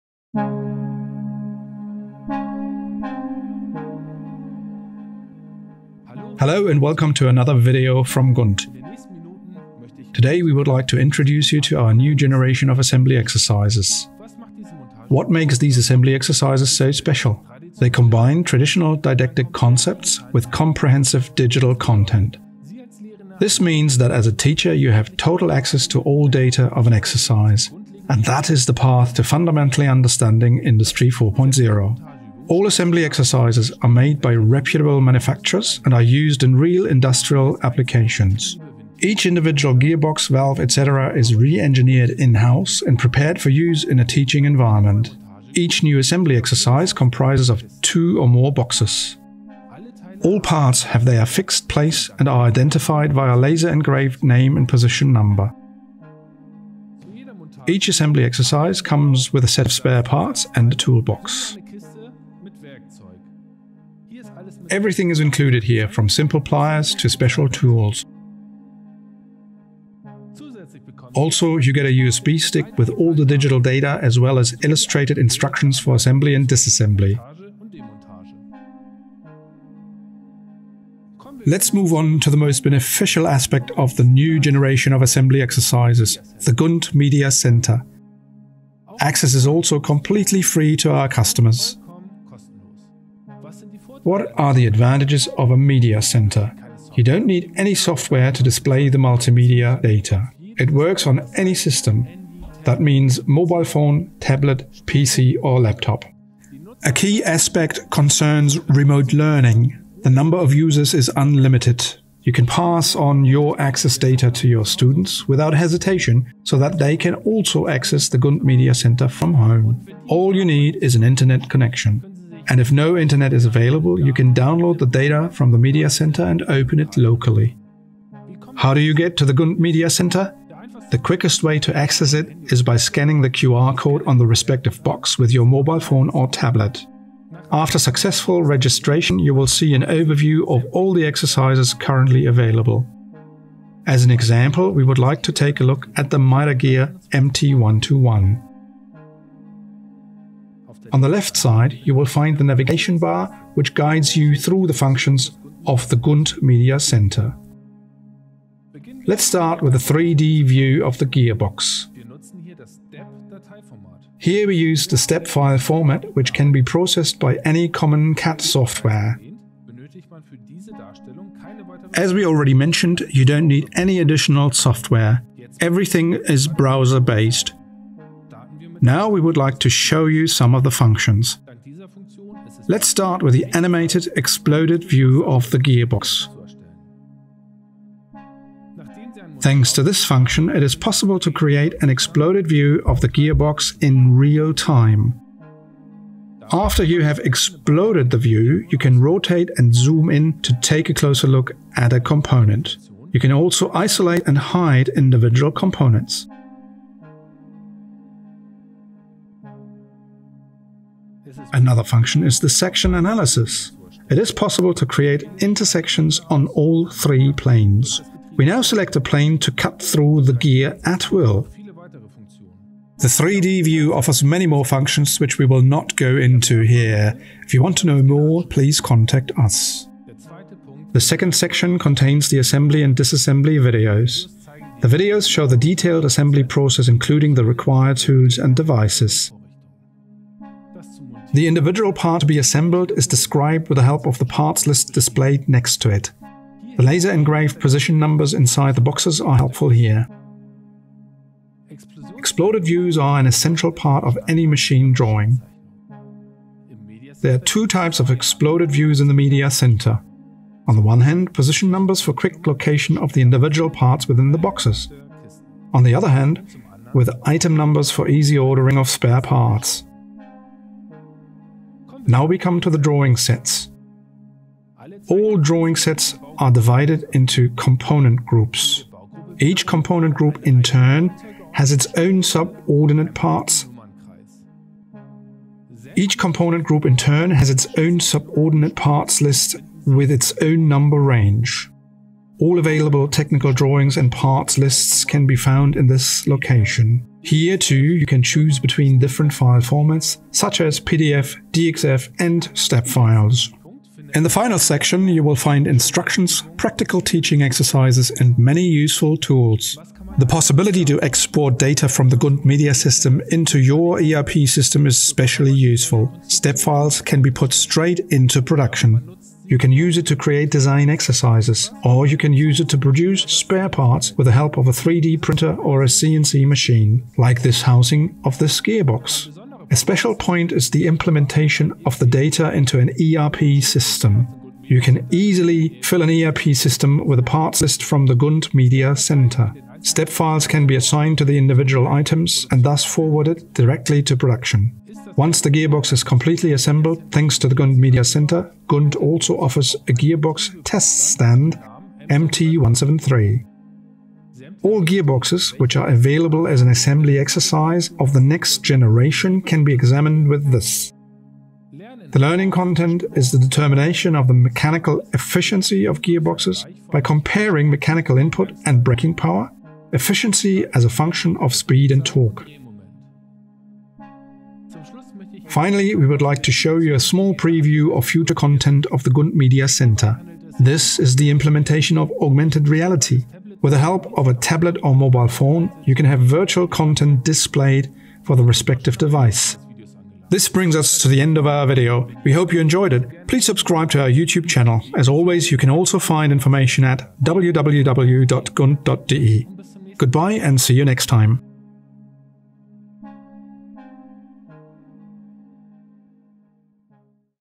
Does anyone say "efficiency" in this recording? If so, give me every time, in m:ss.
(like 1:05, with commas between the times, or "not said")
6:05, 6:09.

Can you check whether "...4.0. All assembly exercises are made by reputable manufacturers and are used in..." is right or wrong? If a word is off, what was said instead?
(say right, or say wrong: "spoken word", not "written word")
right.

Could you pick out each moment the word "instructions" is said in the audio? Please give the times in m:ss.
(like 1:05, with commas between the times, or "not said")
1:15, 5:05.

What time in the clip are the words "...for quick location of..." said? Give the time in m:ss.
4:22.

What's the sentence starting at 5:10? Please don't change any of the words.
The possibility to export data from the GUNT Media System into your ERP system is especially useful.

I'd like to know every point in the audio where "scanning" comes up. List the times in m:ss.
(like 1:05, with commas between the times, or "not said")
2:12.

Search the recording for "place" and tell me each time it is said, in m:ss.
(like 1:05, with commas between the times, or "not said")
0:51.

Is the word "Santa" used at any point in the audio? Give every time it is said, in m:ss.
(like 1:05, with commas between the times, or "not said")
not said.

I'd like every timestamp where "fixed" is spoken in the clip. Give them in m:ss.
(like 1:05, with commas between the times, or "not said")
0:51.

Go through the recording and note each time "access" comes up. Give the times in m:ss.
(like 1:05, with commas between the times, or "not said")
0:25, 1:28, 1:53, 1:57, 2:11.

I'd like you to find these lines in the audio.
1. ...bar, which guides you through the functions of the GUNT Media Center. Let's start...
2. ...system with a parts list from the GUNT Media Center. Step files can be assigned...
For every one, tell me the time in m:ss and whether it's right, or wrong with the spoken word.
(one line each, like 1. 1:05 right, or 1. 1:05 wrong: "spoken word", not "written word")
1. 2:32 right
2. 5:36 right.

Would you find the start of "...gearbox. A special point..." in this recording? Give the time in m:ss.
5:28.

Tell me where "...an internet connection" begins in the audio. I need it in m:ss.
2:00.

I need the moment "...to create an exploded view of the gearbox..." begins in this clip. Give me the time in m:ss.
3:11.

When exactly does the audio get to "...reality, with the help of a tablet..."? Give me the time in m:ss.
6:22.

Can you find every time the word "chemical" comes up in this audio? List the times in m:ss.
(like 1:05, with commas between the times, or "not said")
not said.